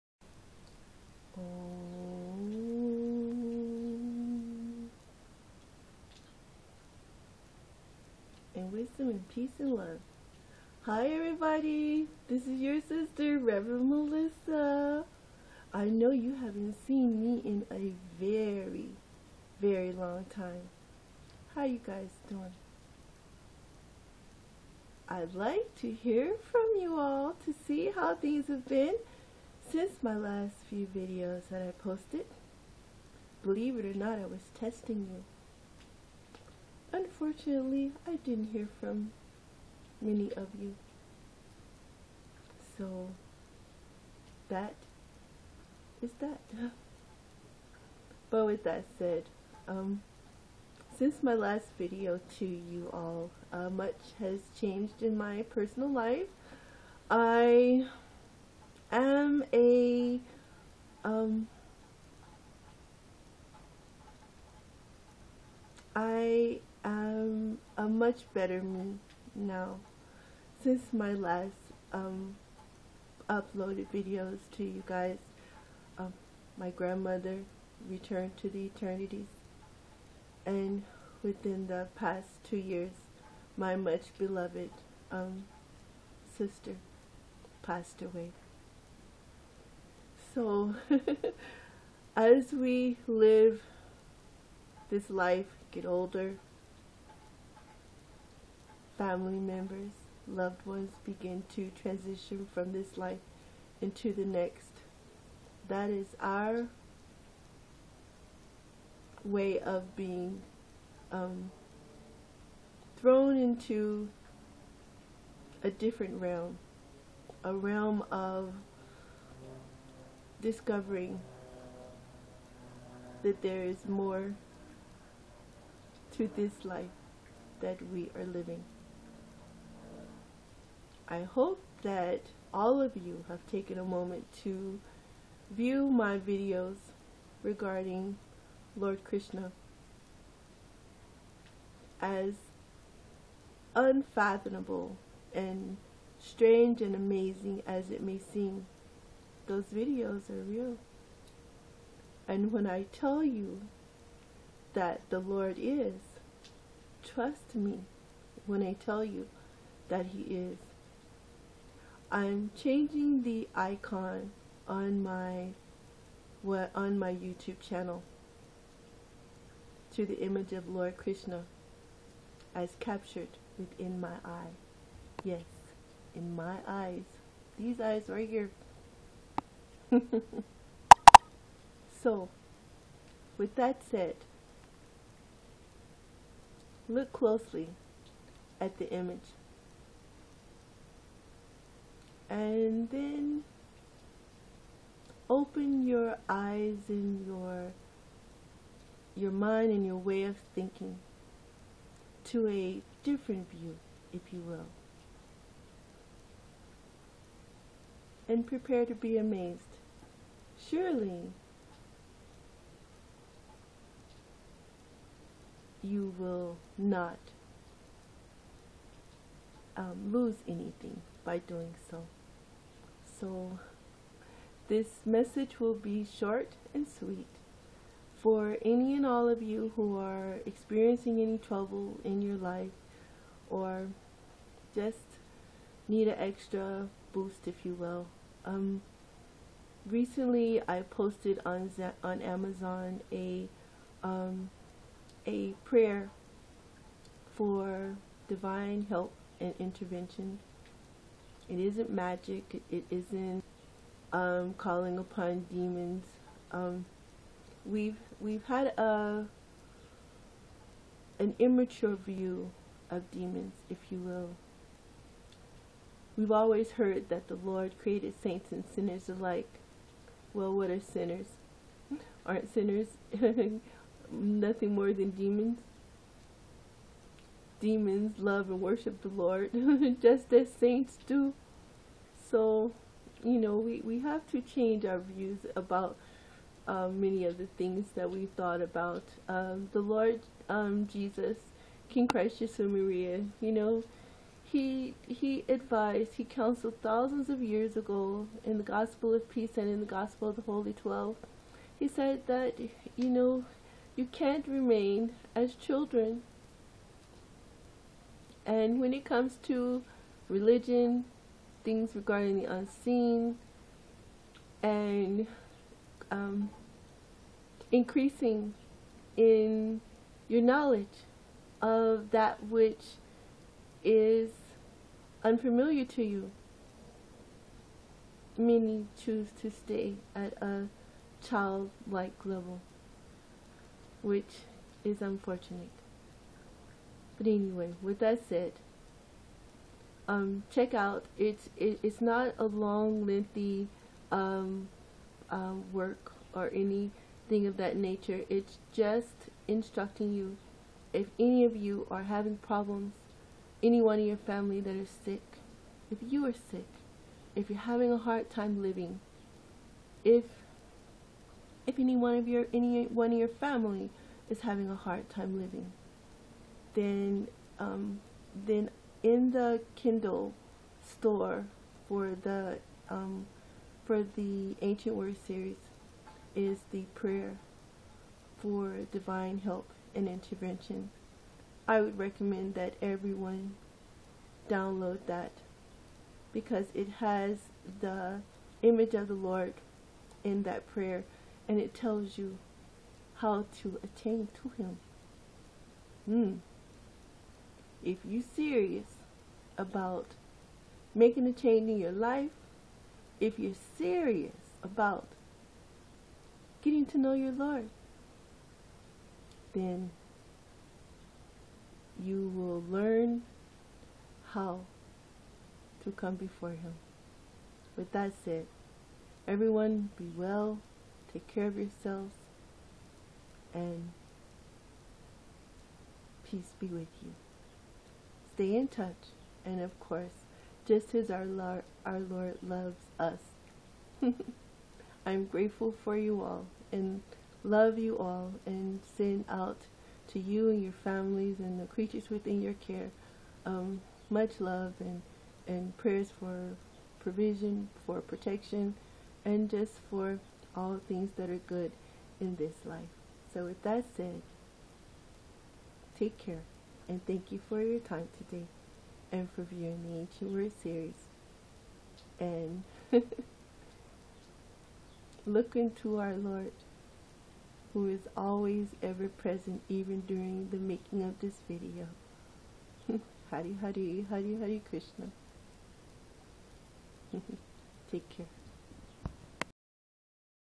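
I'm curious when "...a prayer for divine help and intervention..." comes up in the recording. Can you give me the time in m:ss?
4:05.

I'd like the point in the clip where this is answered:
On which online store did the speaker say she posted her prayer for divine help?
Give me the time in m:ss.
4:02.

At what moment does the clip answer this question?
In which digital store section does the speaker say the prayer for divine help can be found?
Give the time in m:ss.
6:09.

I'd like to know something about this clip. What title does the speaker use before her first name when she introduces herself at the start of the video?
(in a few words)
Reverend.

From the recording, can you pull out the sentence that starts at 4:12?
It isn't um, calling upon demons.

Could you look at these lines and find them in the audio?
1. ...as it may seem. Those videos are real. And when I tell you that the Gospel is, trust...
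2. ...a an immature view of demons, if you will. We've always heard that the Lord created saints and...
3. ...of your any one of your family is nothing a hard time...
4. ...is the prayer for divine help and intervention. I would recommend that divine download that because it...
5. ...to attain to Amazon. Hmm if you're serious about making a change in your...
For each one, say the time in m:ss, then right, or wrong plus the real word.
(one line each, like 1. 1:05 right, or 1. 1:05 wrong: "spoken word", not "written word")
1. 2:27 wrong: "Lord", not "Gospel"
2. 4:18 right
3. 6:02 wrong: "having", not "nothing"
4. 6:16 wrong: "everyone", not "divine"
5. 6:33 wrong: "Him", not "Amazon".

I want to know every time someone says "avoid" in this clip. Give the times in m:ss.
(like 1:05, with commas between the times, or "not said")
not said.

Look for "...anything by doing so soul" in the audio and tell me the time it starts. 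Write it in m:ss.
3:40.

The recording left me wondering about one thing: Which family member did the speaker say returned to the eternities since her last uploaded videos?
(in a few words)
Grandmother.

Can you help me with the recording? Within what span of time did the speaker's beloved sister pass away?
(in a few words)
Two years.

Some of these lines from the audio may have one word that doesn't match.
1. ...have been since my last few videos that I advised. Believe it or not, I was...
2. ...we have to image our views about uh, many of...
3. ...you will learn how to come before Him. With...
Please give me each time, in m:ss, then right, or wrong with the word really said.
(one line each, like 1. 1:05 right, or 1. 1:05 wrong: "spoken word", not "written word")
1. 0:28 wrong: "posted", not "advised"
2. 4:43 wrong: "change", not "image"
3. 6:52 right.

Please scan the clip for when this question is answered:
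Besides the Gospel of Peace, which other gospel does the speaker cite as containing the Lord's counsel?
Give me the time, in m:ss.
4:59.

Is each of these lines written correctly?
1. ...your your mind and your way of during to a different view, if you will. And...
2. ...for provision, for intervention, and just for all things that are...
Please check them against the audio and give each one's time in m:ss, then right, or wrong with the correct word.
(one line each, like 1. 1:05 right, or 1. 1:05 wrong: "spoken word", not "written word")
1. 3:17 wrong: "thinking", not "during"
2. 7:26 wrong: "protection", not "intervention".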